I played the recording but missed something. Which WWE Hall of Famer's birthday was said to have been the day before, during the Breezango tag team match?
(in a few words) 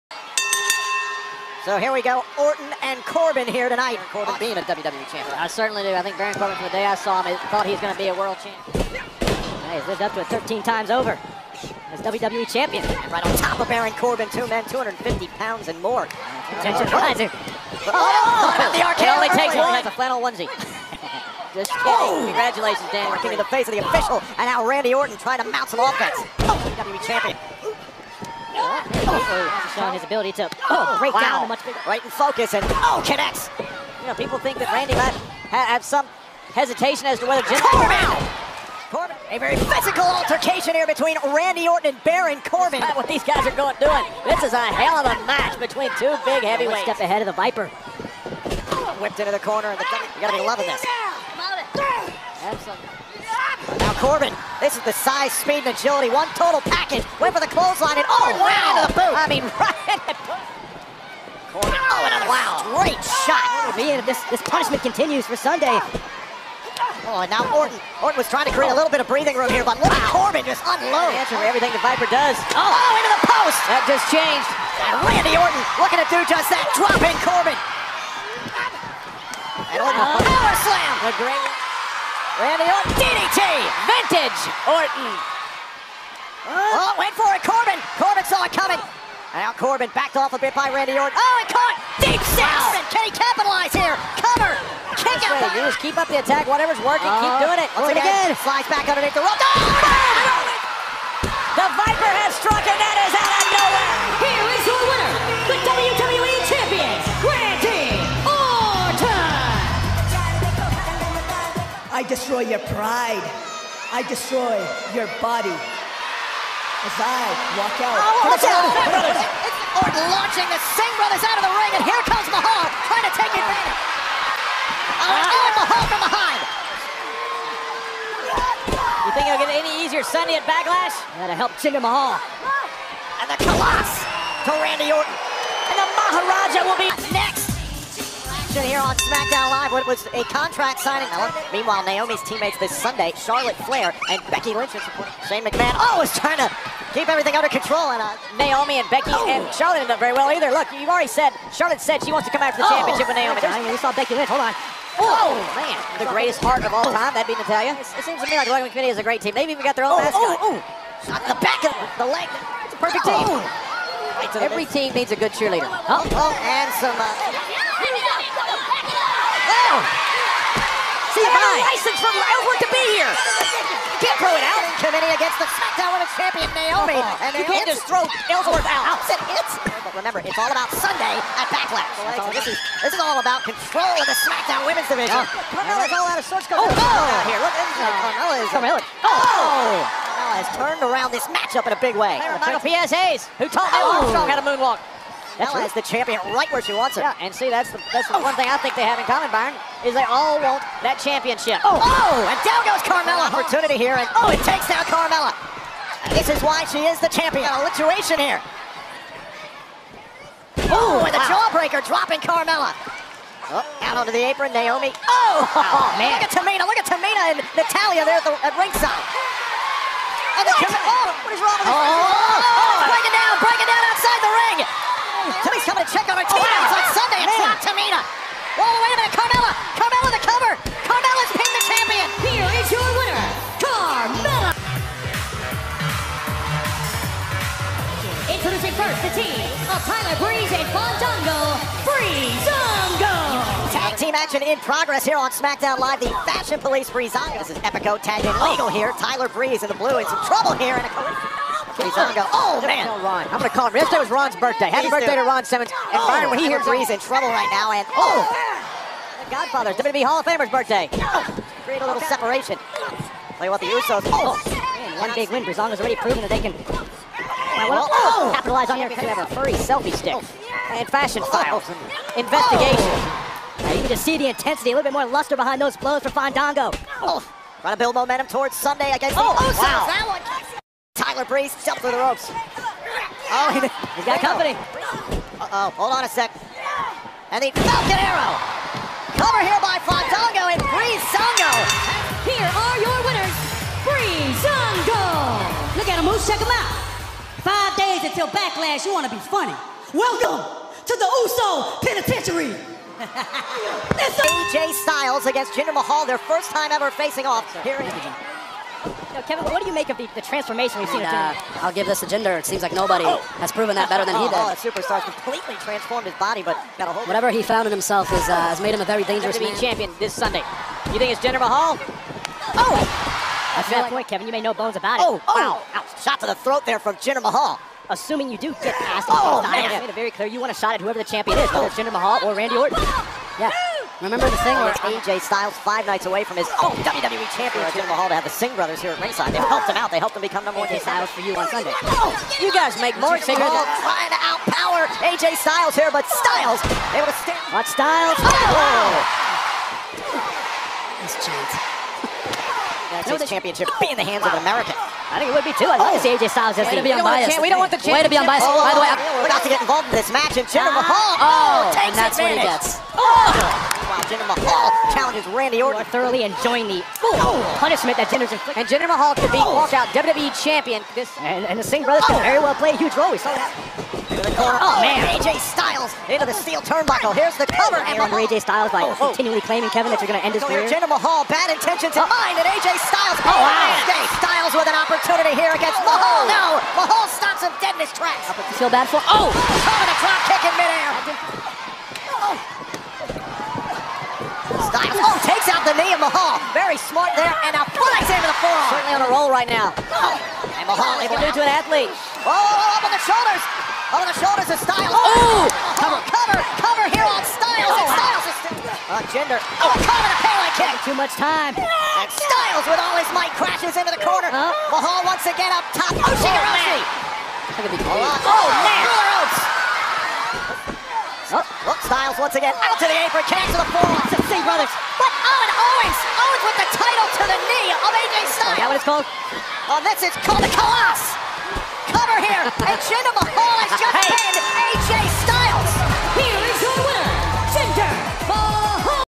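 Ron Simmons.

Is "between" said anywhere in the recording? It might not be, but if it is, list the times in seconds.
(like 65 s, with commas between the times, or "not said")
40 s, 45 s.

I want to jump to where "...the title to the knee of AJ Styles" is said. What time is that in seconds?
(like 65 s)
426 s.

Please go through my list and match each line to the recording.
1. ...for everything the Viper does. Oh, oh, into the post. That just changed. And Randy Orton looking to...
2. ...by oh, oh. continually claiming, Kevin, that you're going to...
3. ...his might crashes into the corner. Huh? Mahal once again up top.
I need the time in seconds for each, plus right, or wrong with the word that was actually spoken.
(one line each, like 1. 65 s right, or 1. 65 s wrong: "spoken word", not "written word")
1. 71 s right
2. 378 s right
3. 412 s right.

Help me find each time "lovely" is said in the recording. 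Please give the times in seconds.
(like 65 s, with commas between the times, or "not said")
not said.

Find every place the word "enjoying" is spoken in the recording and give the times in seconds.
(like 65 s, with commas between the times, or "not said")
366 s.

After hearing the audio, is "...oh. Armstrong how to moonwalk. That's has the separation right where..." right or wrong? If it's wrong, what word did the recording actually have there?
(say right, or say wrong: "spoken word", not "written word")
wrong: "champion", not "separation".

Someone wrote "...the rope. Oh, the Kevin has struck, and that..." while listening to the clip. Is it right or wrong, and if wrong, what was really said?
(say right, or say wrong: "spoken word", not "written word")
wrong: "Viper", not "Kevin".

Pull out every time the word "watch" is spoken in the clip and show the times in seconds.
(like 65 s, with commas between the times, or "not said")
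118 s, 347 s.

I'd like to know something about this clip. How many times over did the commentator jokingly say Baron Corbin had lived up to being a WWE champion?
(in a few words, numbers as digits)
13.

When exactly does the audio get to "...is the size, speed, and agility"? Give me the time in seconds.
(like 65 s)
54 s.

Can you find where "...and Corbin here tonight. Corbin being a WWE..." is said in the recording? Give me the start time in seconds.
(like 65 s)
2 s.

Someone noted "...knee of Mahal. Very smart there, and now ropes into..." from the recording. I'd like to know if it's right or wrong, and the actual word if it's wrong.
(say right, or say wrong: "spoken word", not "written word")
wrong: "flies", not "ropes".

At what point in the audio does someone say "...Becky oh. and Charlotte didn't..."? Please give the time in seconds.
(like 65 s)
148 s.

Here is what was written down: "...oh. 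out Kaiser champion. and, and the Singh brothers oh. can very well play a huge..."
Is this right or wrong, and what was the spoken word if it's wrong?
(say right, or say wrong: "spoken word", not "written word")
wrong: "WWE", not "Kaiser".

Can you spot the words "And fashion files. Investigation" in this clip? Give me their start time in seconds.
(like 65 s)
270 s.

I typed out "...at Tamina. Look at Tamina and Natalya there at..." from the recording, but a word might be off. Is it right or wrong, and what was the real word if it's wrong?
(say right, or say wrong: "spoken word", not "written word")
right.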